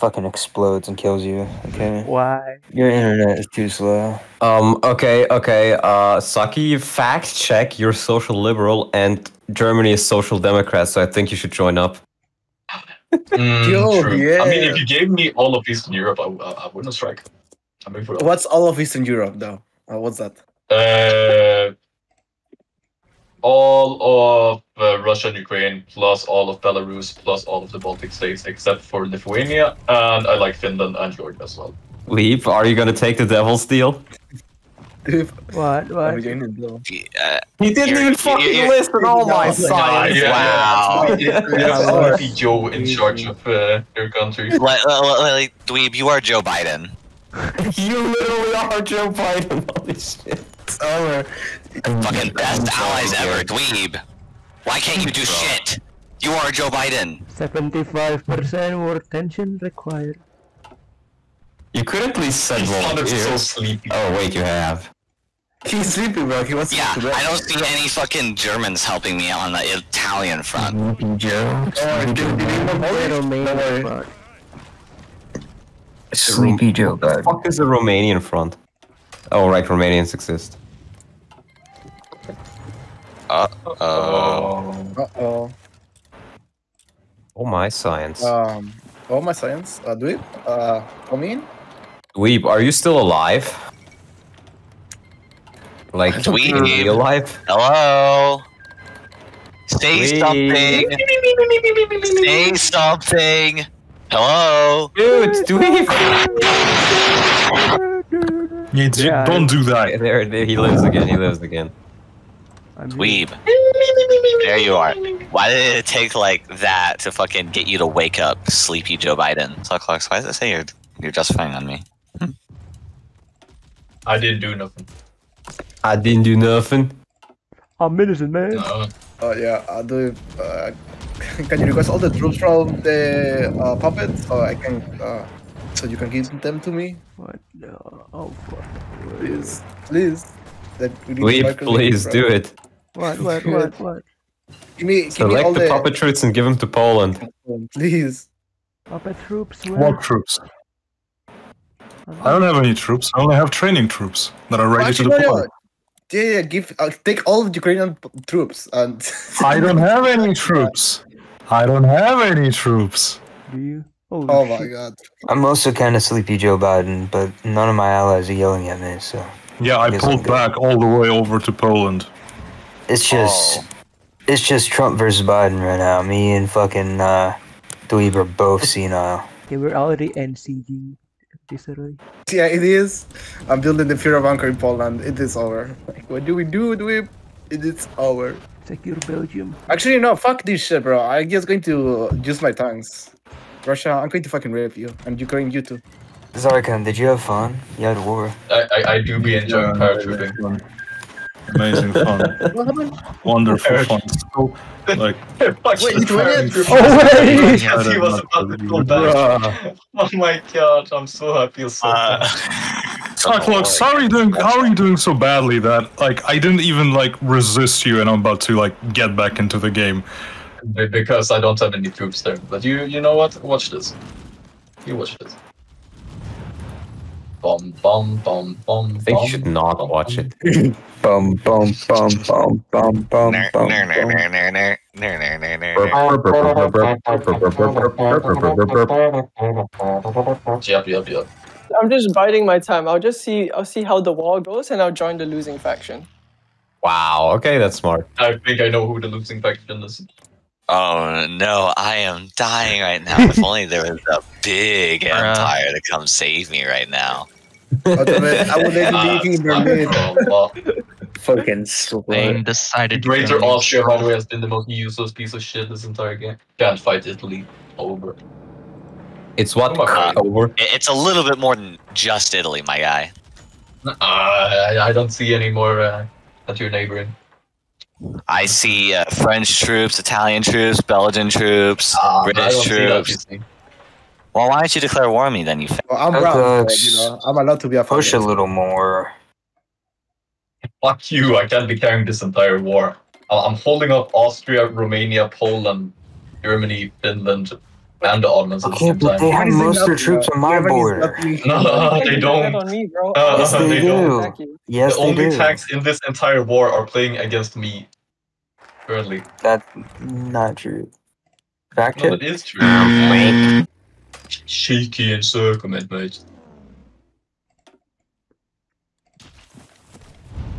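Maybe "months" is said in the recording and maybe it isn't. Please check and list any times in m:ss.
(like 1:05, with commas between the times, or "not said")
not said.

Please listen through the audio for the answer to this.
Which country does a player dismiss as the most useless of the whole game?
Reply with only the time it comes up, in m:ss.
4:21.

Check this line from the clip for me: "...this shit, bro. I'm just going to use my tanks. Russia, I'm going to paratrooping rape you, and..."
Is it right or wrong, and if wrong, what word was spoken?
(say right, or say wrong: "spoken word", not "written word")
wrong: "fucking", not "paratrooping".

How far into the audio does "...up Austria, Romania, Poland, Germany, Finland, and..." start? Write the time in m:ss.
4:53.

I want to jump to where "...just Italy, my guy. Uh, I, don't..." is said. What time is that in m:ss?
4:31.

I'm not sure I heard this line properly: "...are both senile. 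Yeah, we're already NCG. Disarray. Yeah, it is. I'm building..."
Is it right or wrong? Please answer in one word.
right.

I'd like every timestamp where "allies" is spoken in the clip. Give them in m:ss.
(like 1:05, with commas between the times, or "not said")
0:52, 2:47.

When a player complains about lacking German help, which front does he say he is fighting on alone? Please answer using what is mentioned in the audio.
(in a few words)
Italian front.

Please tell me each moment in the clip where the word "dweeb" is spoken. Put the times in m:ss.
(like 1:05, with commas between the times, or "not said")
0:45, 0:53, 1:40, 2:57.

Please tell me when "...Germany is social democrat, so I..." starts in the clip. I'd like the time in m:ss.
0:09.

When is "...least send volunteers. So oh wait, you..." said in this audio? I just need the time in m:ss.
1:02.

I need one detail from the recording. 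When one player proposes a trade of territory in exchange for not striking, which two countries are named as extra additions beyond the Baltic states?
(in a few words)
Finland and Georgia.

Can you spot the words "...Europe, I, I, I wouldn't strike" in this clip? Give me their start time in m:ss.
0:15.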